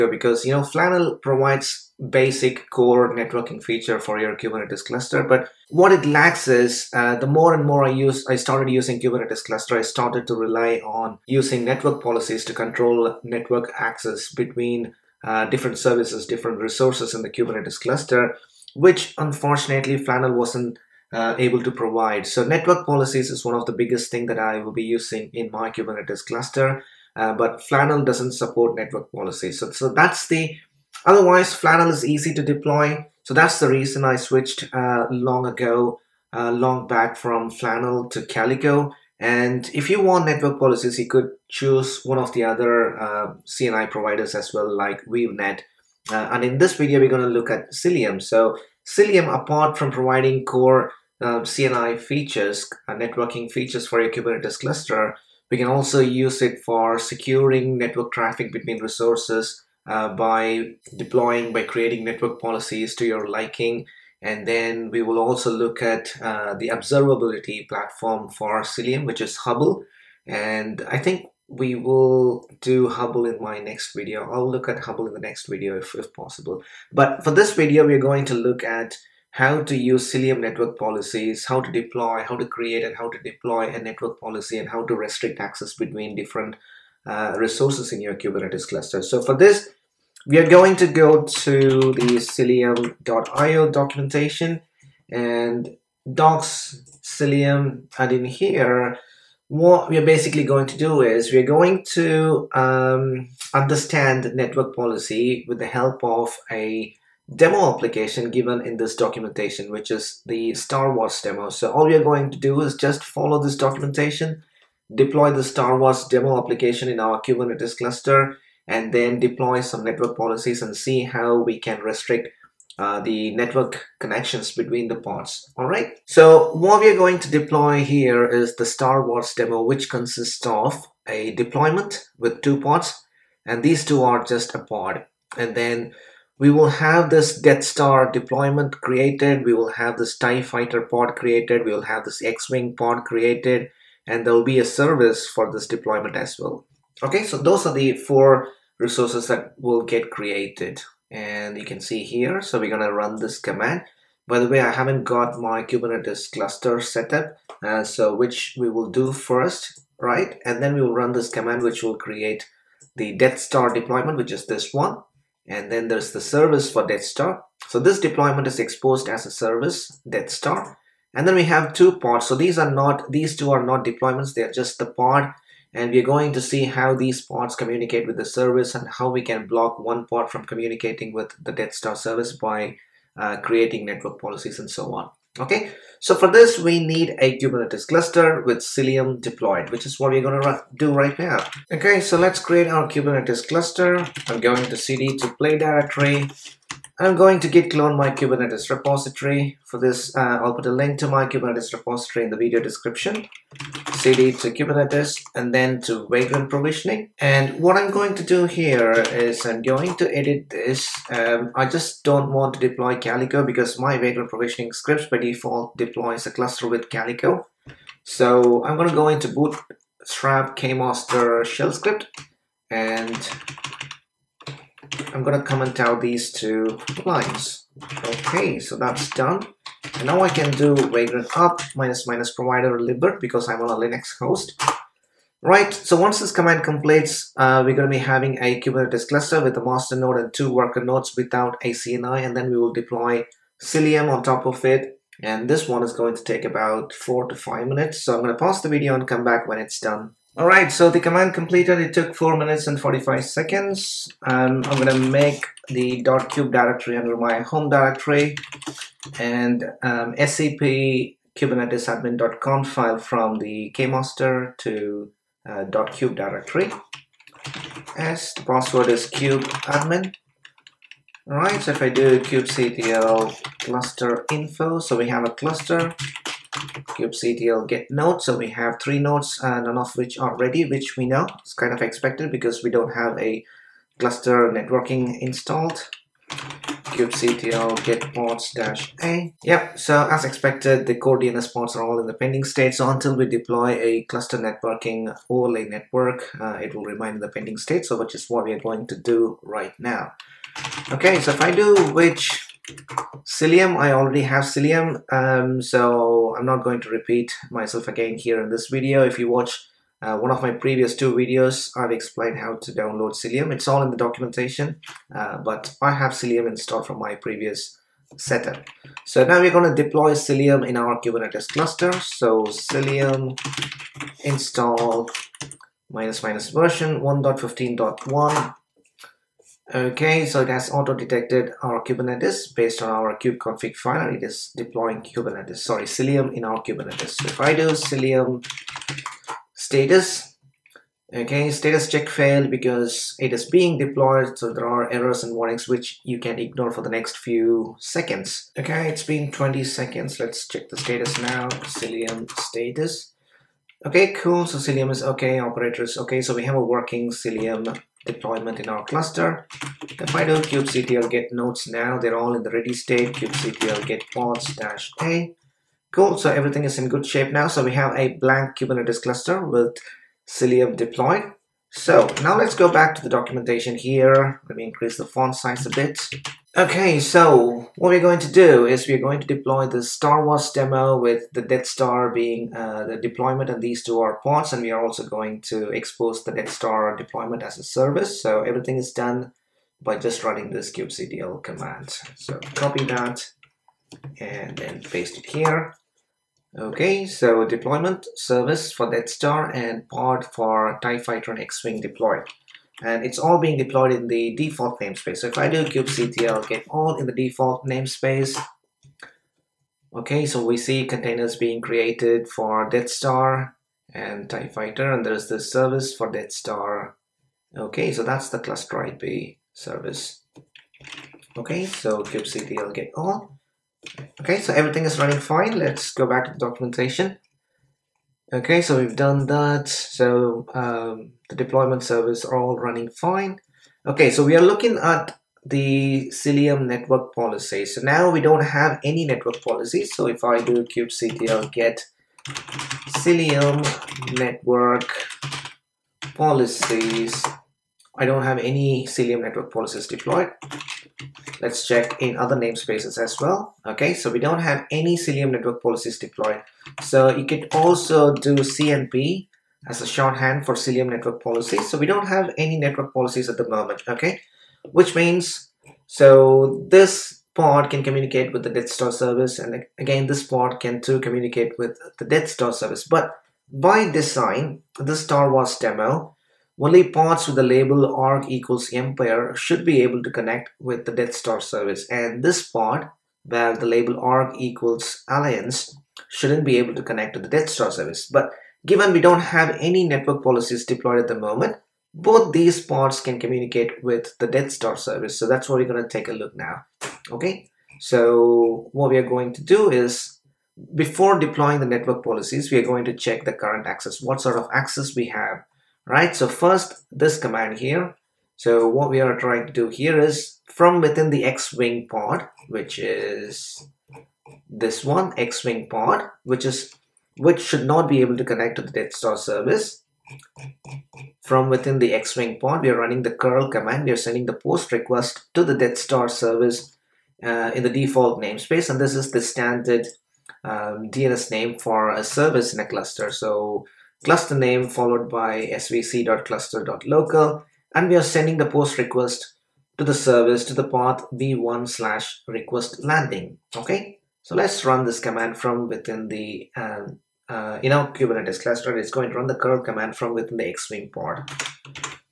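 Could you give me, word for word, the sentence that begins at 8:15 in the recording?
So that's what we're going to take a look now.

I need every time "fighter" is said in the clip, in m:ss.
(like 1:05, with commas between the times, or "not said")
2:20, 6:40, 6:54.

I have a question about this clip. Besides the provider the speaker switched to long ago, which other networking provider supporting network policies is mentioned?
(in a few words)
WeaveNet.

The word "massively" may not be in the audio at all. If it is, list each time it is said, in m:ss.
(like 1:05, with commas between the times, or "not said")
not said.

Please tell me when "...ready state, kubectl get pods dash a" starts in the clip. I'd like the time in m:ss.
6:02.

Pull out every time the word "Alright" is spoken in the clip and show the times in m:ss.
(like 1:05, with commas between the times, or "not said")
4:10, 4:31.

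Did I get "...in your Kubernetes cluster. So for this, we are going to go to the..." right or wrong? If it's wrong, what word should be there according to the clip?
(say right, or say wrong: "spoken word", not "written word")
right.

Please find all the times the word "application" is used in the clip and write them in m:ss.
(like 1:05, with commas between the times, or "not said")
1:47, 1:56.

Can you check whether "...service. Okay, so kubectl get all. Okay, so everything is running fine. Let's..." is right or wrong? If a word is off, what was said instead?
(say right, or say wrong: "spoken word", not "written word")
right.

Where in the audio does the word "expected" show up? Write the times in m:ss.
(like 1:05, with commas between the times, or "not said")
4:41, 4:50.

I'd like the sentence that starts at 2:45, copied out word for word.
And then there's the service for Death Star.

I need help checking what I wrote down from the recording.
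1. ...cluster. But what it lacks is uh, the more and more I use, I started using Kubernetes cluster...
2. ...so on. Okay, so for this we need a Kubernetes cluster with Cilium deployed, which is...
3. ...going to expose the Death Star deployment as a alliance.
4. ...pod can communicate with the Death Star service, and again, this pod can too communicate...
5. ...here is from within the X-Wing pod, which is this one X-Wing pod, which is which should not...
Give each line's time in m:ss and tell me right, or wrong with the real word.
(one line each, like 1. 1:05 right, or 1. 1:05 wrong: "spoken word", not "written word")
1. 0:04 right
2. 3:04 right
3. 6:25 wrong: "service", not "alliance"
4. 7:47 right
5. 8:29 right.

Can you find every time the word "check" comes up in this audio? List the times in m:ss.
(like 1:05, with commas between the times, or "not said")
5:41, 5:50, 7:31, 8:22.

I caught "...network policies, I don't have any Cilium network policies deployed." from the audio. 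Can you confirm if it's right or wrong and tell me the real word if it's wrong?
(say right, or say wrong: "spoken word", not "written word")
right.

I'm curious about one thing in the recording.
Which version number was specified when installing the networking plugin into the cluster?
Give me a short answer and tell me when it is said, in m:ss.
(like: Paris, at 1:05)
1.15.1, at 5:27.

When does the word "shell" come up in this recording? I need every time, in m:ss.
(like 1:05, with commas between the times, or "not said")
3:41.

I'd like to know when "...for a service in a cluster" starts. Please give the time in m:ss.
8:51.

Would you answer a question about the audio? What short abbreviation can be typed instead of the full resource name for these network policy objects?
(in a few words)
CNP.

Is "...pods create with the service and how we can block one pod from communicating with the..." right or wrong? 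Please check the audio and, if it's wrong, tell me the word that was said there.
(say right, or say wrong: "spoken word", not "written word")
wrong: "communicate", not "create".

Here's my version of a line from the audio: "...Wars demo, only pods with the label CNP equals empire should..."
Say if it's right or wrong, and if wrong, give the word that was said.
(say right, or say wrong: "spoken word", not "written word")
wrong: "ARC", not "CNP".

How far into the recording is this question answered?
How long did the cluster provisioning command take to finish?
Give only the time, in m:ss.
4:12.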